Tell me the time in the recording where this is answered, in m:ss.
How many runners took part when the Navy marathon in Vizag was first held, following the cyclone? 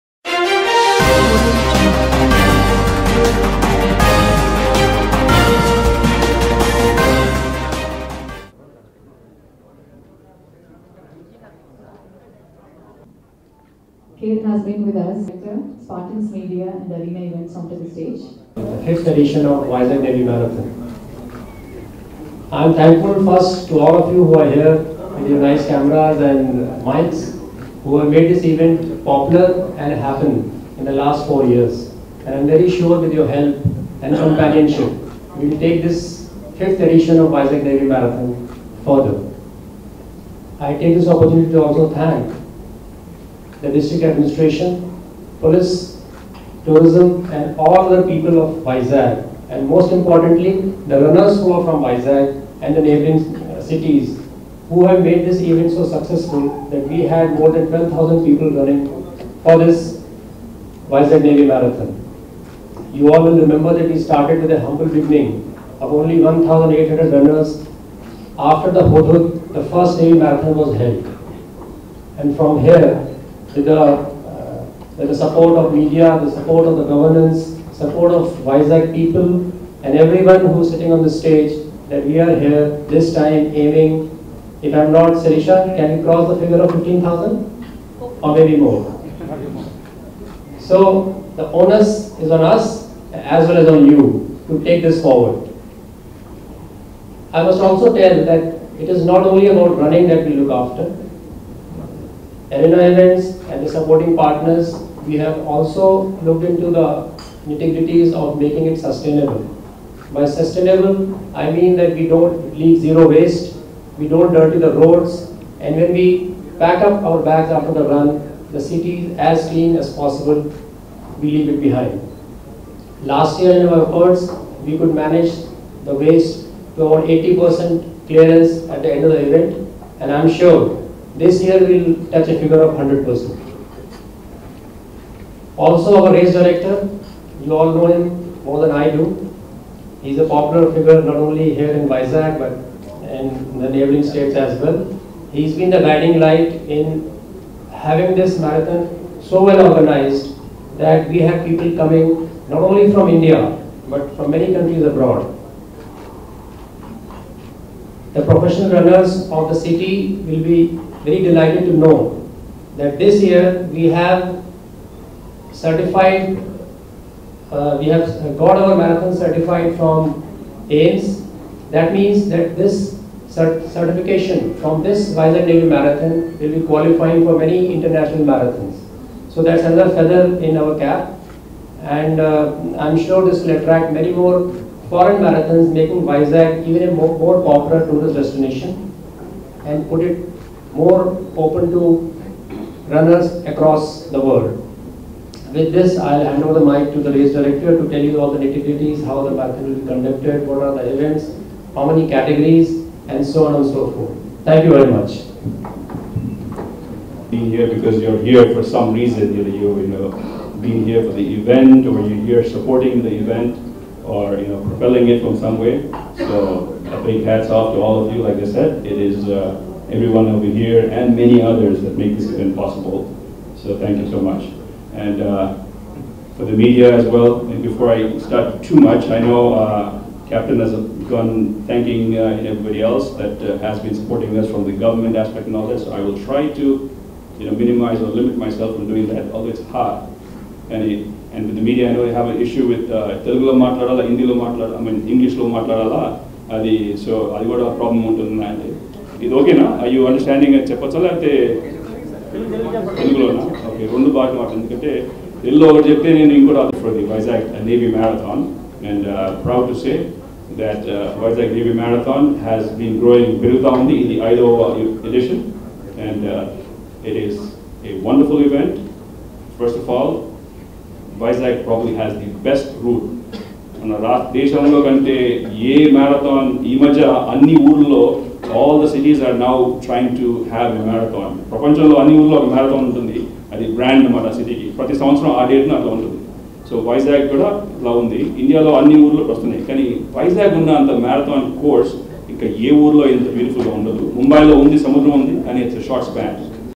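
1:06.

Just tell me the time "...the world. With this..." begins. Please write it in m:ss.
3:14.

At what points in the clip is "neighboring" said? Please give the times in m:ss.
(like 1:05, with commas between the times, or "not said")
0:52, 2:23.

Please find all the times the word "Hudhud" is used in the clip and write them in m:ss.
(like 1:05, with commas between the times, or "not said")
1:08.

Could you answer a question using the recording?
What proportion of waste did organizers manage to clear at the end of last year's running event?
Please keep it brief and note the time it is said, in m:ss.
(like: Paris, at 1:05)
80%, at 2:07.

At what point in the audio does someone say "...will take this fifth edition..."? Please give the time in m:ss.
0:35.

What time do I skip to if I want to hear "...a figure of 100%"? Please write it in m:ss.
2:12.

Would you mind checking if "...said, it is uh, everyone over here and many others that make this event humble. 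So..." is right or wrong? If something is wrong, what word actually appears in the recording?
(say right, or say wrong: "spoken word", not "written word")
wrong: "possible", not "humble".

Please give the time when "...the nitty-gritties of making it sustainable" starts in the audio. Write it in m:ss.
1:46.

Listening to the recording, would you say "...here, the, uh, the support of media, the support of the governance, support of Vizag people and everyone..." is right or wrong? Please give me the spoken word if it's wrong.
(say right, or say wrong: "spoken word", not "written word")
right.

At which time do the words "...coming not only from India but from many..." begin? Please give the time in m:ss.
2:31.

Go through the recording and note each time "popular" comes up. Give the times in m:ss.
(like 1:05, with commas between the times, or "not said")
0:29, 2:20, 3:07.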